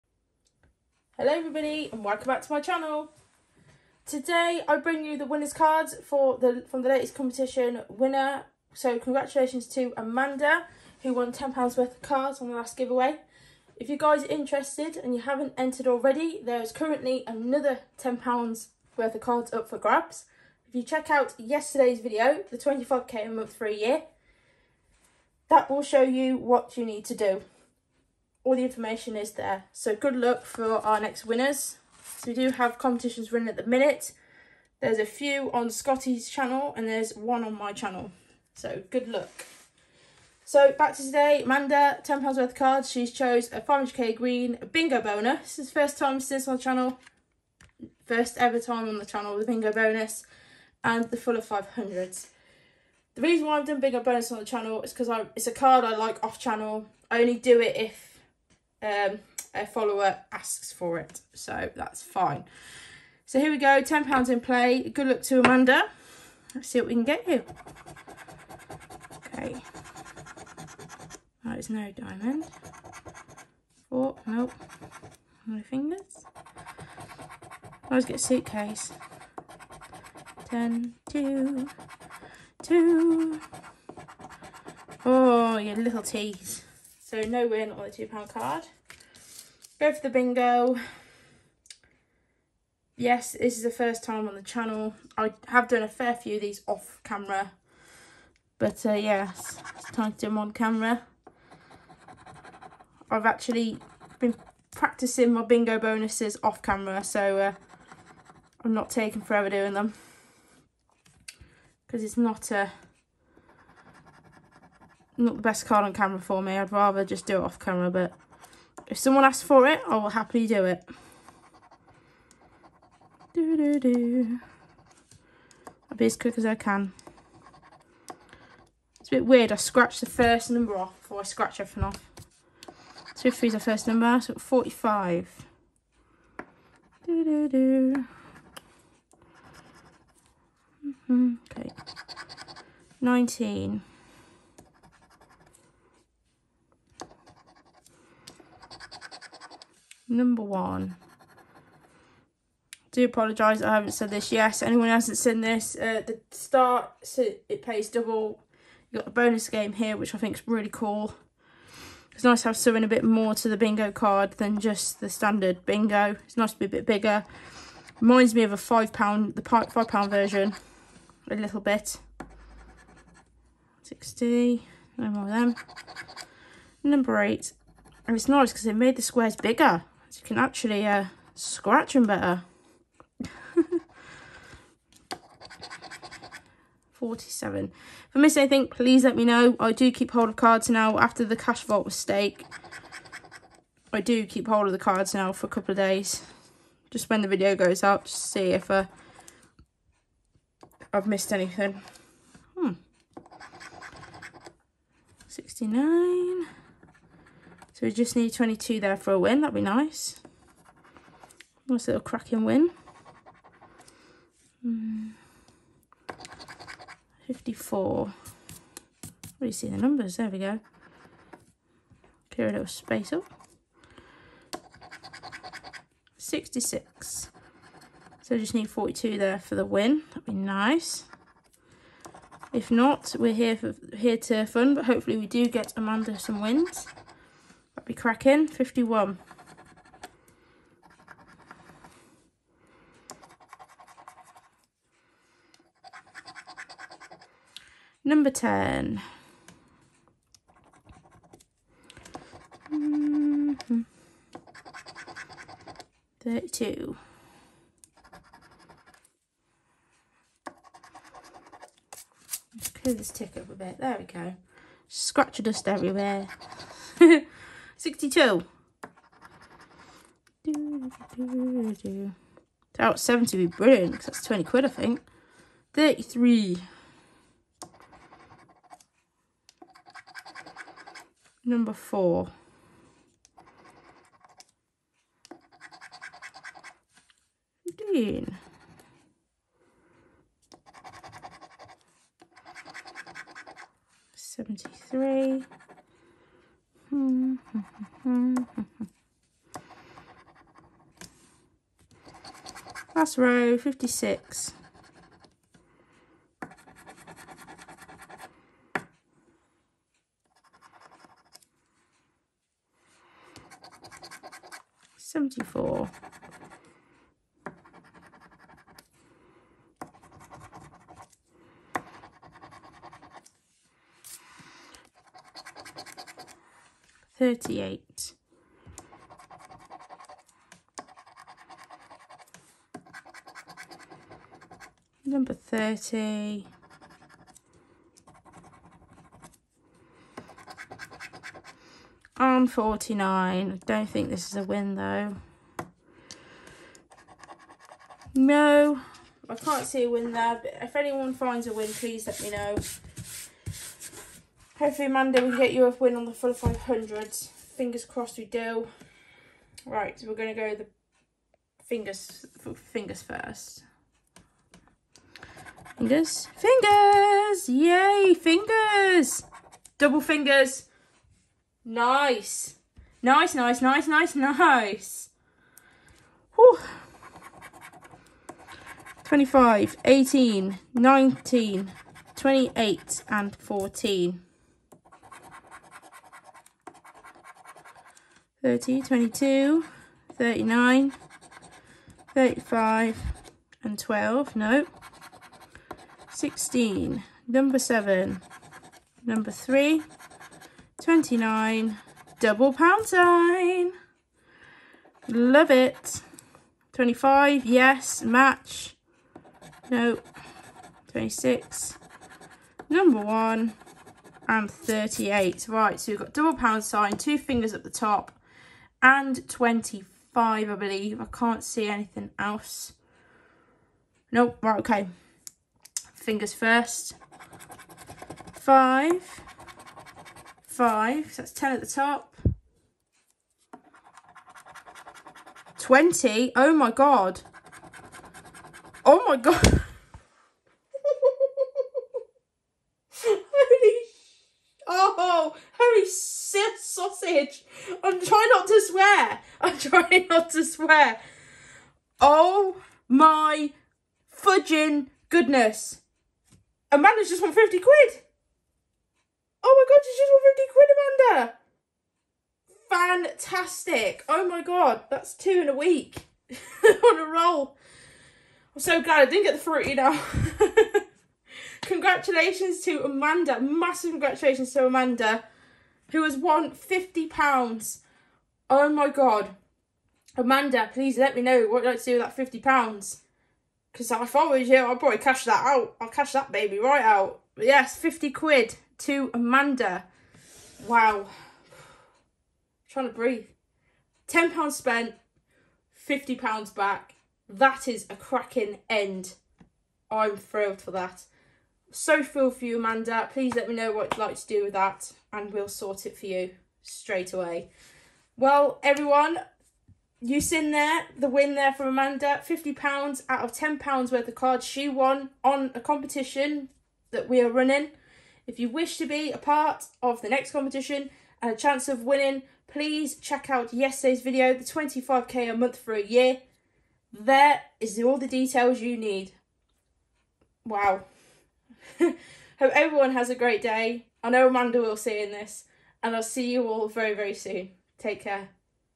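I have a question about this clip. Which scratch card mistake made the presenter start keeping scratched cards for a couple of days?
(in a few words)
Cash vault.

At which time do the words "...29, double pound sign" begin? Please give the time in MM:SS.
06:40.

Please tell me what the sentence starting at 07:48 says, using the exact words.
I'm so glad I didn't get the fruit.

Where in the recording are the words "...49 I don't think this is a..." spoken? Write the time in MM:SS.
05:42.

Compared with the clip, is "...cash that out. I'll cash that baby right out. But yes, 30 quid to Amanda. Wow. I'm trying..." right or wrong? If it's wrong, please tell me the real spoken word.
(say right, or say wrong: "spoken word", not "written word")
wrong: "50", not "30".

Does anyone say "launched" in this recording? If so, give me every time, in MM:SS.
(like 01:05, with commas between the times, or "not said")
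not said.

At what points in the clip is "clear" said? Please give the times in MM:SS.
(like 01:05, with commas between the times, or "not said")
03:42, 04:22.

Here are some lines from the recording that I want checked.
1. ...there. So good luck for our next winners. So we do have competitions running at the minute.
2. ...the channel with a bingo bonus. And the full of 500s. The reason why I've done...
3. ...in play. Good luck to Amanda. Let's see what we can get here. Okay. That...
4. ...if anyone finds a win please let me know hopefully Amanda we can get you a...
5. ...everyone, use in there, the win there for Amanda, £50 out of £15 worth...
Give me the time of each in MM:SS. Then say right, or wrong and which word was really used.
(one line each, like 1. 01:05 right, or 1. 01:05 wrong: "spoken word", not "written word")
1. 00:29 right
2. 00:48 right
3. 01:04 right
4. 05:50 wrong: "Monday", not "Amanda"
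5. 08:28 wrong: "10", not "15".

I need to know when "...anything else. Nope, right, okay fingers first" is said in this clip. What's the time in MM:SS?
07:01.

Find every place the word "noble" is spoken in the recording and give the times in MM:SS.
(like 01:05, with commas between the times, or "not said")
not said.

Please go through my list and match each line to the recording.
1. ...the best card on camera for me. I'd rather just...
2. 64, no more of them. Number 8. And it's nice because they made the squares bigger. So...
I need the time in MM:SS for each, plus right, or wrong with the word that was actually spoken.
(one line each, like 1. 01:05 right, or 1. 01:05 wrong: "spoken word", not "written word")
1. 01:55 right
2. 02:53 wrong: "60", not "64".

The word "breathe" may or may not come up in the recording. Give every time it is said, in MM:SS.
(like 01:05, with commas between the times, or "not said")
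08:12.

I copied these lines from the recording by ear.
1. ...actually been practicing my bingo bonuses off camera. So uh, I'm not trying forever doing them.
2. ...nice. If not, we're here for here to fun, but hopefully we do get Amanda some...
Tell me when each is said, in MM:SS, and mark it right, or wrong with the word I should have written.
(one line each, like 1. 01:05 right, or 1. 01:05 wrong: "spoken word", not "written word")
1. 01:43 wrong: "taking", not "trying"
2. 03:50 right.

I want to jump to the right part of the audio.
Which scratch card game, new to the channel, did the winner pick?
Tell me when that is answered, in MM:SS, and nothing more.
00:43.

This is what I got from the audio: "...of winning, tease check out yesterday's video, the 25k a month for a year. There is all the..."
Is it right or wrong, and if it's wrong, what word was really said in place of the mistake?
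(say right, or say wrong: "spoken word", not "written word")
wrong: "please", not "tease".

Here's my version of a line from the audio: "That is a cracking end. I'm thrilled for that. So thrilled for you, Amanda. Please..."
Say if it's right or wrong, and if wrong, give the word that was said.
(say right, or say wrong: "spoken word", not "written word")
right.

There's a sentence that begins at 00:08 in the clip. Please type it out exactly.
So congratulations to Amanda who won £10 worth of cards on the last giveaway.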